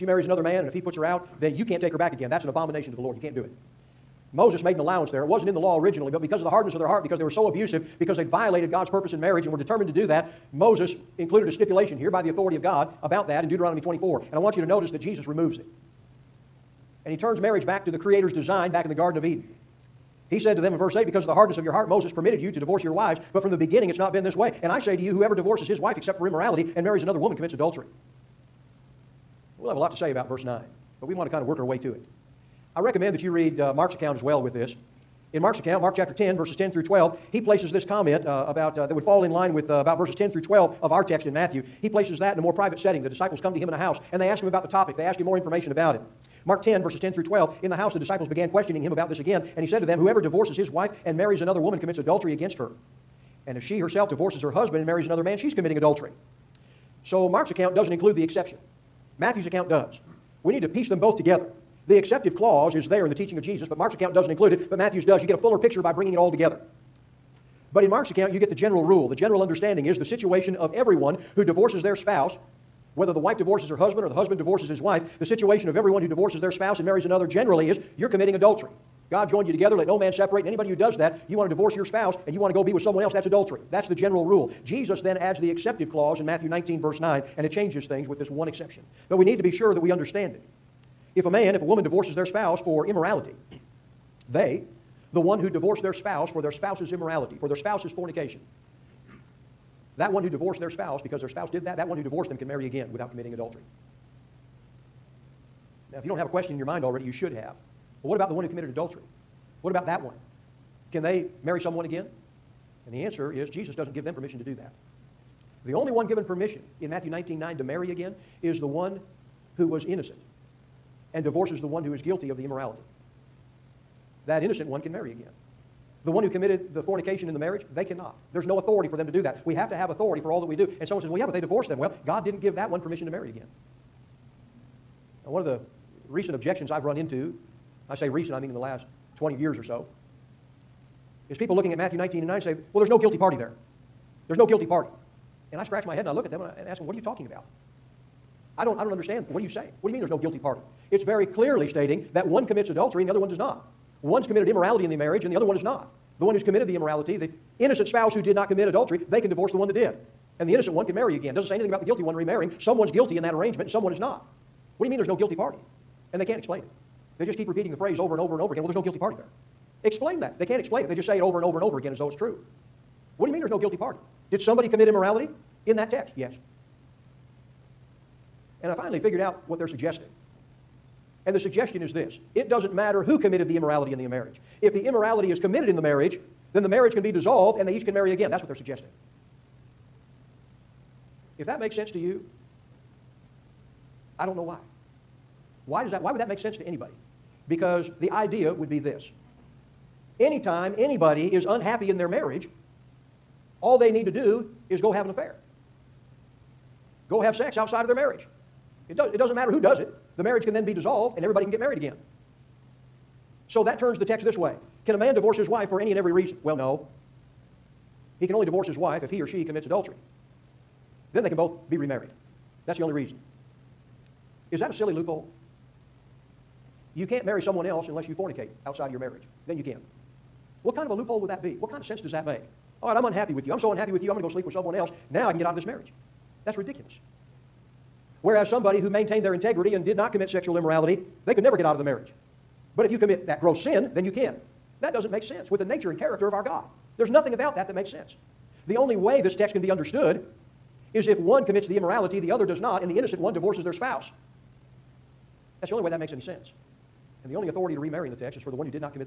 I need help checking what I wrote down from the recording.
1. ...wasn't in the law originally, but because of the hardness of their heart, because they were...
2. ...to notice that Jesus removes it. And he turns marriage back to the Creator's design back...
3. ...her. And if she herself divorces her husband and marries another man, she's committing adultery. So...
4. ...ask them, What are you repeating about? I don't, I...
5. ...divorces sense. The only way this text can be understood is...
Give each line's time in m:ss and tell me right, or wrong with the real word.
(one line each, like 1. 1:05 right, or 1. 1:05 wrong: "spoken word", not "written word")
1. 0:05 right
2. 0:14 right
3. 0:52 right
4. 2:26 wrong: "talking", not "repeating"
5. 4:07 wrong: "makes", not "divorces".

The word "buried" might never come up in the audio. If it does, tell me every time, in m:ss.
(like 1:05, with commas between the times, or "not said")
not said.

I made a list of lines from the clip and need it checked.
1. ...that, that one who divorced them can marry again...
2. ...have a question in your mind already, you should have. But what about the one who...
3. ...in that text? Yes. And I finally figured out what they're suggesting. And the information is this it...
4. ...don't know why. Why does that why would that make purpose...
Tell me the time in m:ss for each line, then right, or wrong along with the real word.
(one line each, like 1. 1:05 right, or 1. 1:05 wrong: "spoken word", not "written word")
1. 1:41 right
2. 1:46 right
3. 2:55 wrong: "suggestion", not "information"
4. 3:14 wrong: "sense", not "purpose".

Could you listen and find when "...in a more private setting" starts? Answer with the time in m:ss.
0:42.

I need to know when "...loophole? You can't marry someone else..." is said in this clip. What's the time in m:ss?
3:44.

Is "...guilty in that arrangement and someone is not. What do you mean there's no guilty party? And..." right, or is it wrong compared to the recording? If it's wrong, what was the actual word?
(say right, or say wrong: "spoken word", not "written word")
right.